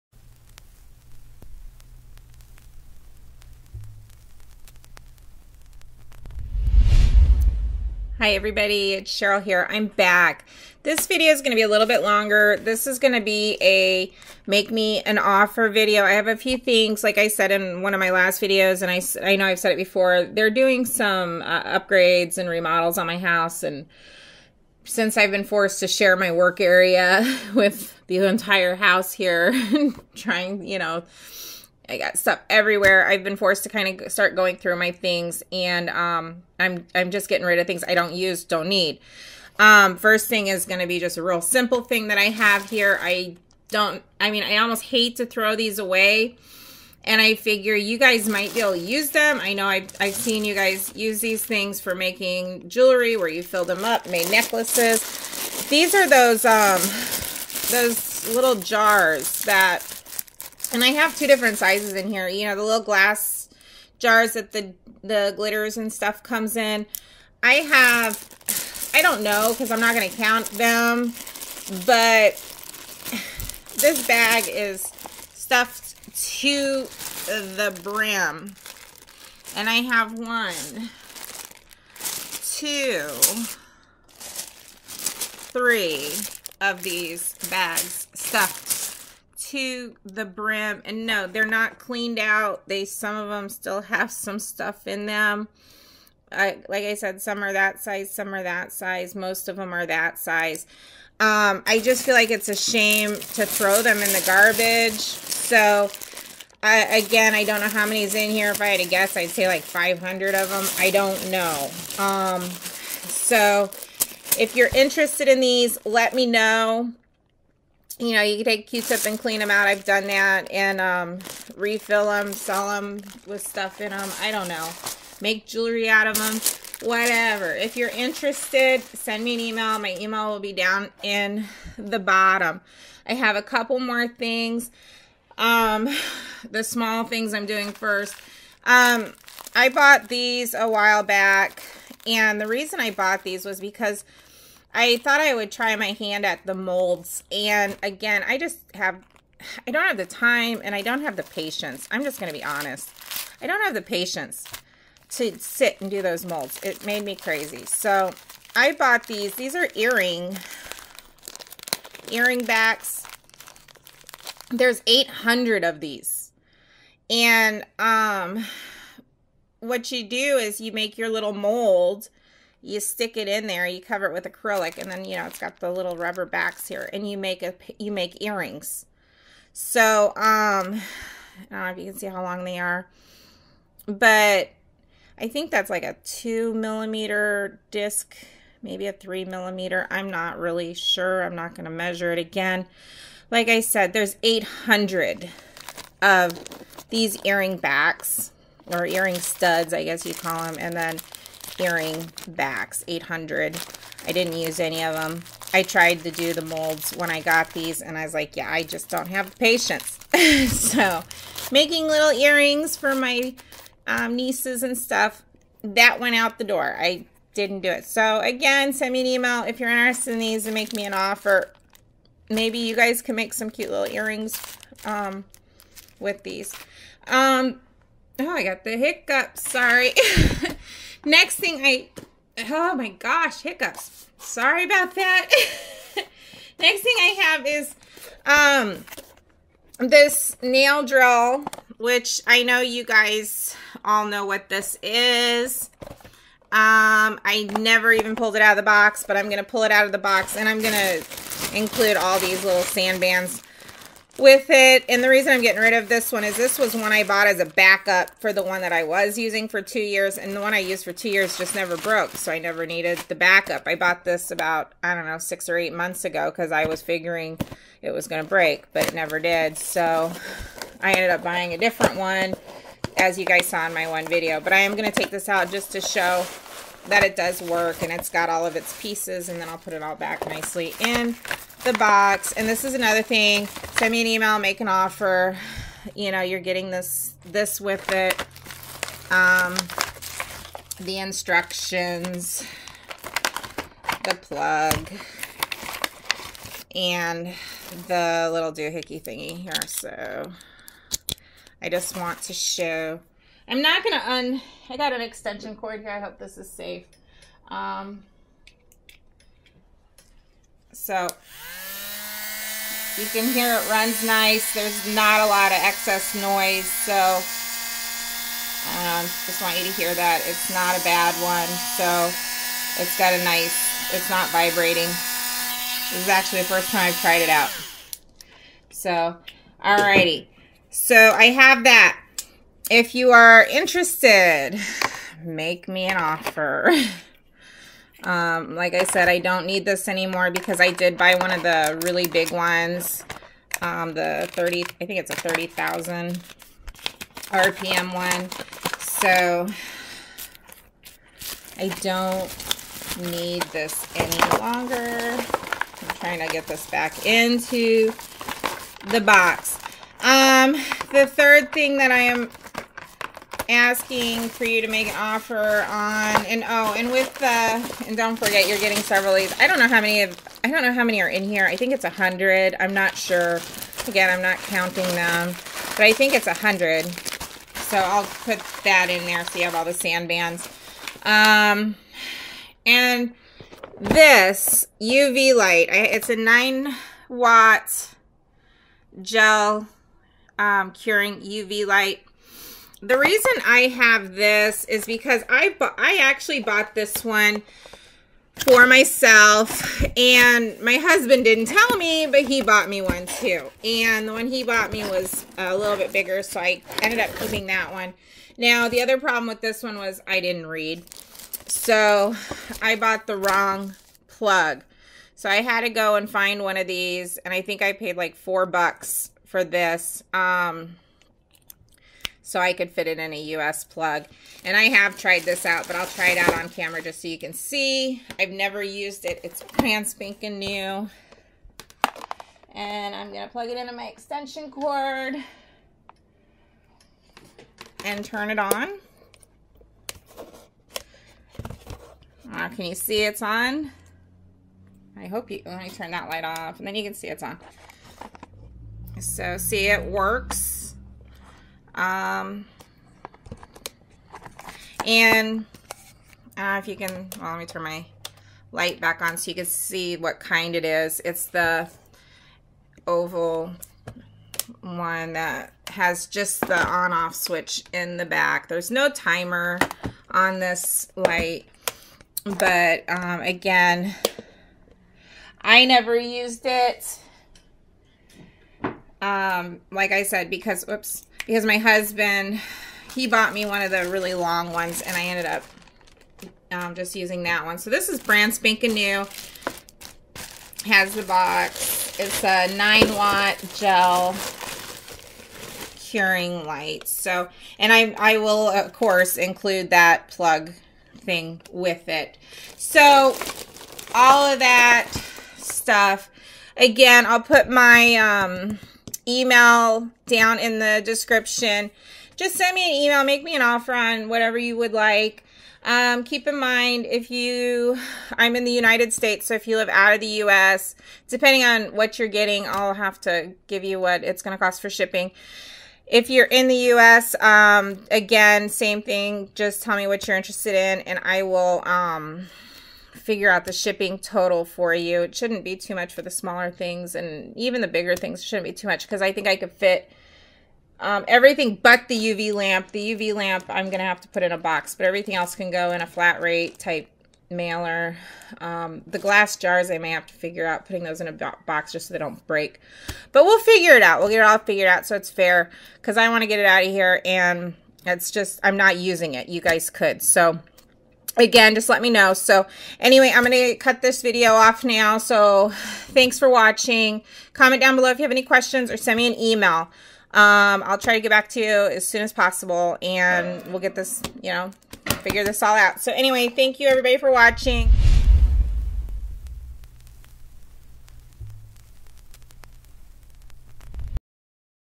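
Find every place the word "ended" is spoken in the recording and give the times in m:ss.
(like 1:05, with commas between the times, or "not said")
4:30, 6:46, 8:05.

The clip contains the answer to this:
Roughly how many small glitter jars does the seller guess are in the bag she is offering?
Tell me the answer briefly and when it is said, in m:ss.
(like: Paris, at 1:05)
500, at 1:49.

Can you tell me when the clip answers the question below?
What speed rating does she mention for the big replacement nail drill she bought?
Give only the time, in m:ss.
5:45.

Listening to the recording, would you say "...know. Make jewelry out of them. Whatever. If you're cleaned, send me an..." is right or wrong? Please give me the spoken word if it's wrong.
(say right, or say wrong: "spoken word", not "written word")
wrong: "interested", not "cleaned".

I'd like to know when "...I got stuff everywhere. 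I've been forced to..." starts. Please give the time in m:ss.
0:31.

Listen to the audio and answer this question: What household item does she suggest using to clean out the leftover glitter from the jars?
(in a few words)
Q-tip.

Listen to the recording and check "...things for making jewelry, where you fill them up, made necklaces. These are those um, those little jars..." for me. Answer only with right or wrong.
right.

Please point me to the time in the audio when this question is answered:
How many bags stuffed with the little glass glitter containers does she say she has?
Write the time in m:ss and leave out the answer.
1:20.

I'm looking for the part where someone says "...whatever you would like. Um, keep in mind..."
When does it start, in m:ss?
8:34.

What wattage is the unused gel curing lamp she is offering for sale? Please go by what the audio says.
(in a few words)
9 watt.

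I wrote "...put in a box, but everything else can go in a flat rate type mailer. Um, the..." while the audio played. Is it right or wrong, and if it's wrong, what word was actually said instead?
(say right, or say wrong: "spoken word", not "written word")
right.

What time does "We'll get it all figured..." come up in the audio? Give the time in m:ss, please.
9:13.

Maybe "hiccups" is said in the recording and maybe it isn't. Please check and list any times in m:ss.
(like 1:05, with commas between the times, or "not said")
3:48, 3:53.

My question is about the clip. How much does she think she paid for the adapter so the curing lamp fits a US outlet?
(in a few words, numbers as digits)
$4.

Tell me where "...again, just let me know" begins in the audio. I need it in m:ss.
9:21.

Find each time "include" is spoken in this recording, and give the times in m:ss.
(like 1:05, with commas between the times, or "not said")
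4:11, 8:19.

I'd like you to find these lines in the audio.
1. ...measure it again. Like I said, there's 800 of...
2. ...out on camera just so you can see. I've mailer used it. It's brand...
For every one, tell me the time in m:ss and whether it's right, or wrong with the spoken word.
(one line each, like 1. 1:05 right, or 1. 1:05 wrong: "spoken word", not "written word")
1. 3:11 right
2. 7:06 wrong: "never", not "mailer".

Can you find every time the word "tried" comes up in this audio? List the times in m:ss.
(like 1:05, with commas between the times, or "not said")
3:25, 5:26, 7:04.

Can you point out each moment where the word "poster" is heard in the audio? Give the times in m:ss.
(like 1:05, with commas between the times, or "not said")
not said.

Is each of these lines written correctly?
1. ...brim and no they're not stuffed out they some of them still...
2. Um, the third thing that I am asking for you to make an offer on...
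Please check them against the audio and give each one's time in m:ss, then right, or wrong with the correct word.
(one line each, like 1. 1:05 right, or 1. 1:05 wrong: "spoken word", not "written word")
1. 1:30 wrong: "cleaned", not "stuffed"
2. 6:00 right.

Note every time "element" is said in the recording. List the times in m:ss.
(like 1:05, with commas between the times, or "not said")
not said.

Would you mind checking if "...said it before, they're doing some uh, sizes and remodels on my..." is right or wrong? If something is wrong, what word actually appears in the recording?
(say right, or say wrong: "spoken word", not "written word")
wrong: "upgrades", not "sizes".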